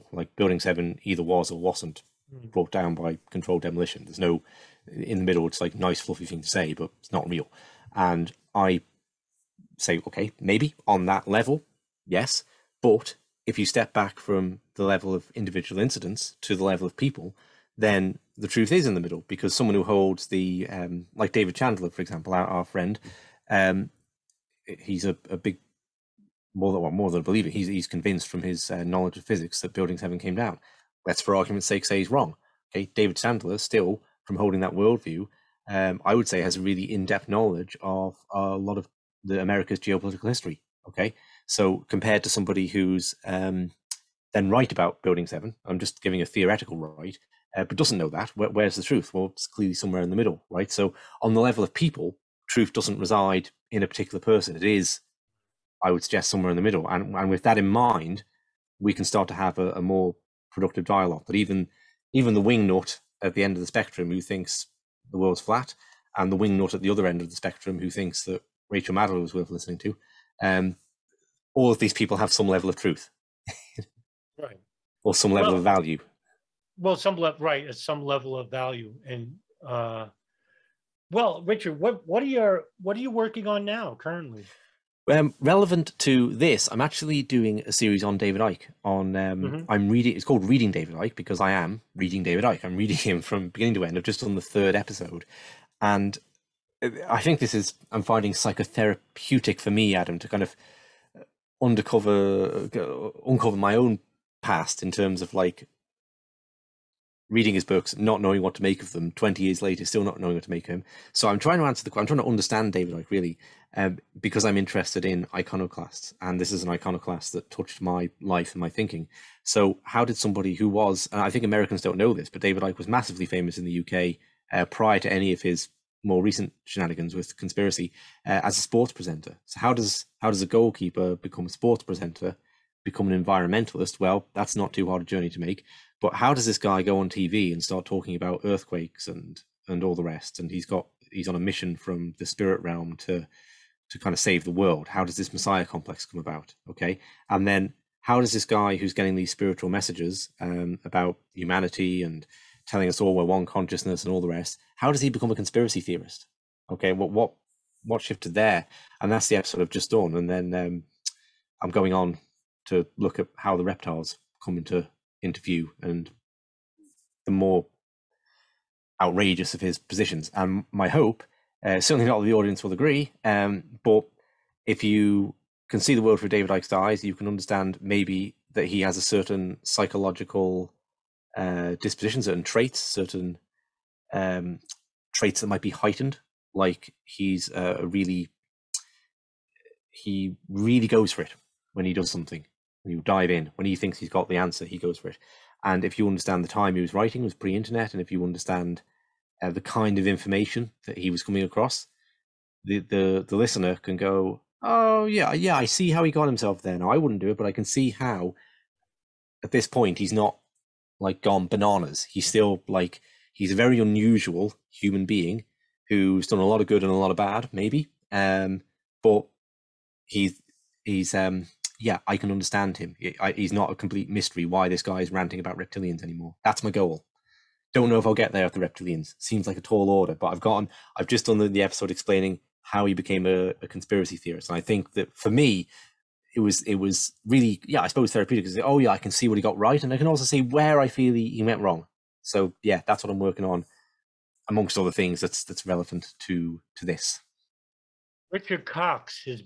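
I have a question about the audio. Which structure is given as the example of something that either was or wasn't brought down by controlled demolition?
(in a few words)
Building 7.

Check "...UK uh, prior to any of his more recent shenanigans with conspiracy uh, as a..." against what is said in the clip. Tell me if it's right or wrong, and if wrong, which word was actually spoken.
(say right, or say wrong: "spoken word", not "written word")
right.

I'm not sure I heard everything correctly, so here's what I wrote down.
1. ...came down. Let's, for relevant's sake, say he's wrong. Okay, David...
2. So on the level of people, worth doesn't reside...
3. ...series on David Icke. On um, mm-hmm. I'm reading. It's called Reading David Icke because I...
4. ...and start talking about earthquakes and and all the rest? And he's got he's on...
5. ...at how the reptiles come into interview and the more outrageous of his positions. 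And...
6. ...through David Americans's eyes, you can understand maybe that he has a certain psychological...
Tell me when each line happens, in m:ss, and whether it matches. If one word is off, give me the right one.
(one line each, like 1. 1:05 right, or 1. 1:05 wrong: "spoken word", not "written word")
1. 0:30 wrong: "argument", not "relevant"
2. 0:50 wrong: "truth", not "worth"
3. 1:27 right
4. 2:17 right
5. 2:43 right
6. 2:56 wrong: "Icke", not "Americans".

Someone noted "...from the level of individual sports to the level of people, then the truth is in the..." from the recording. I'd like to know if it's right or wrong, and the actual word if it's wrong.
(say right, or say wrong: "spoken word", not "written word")
wrong: "incidents", not "sports".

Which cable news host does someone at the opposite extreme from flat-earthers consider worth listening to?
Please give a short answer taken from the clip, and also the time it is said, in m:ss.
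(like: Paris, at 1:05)
Rachel Maddow, at 1:08.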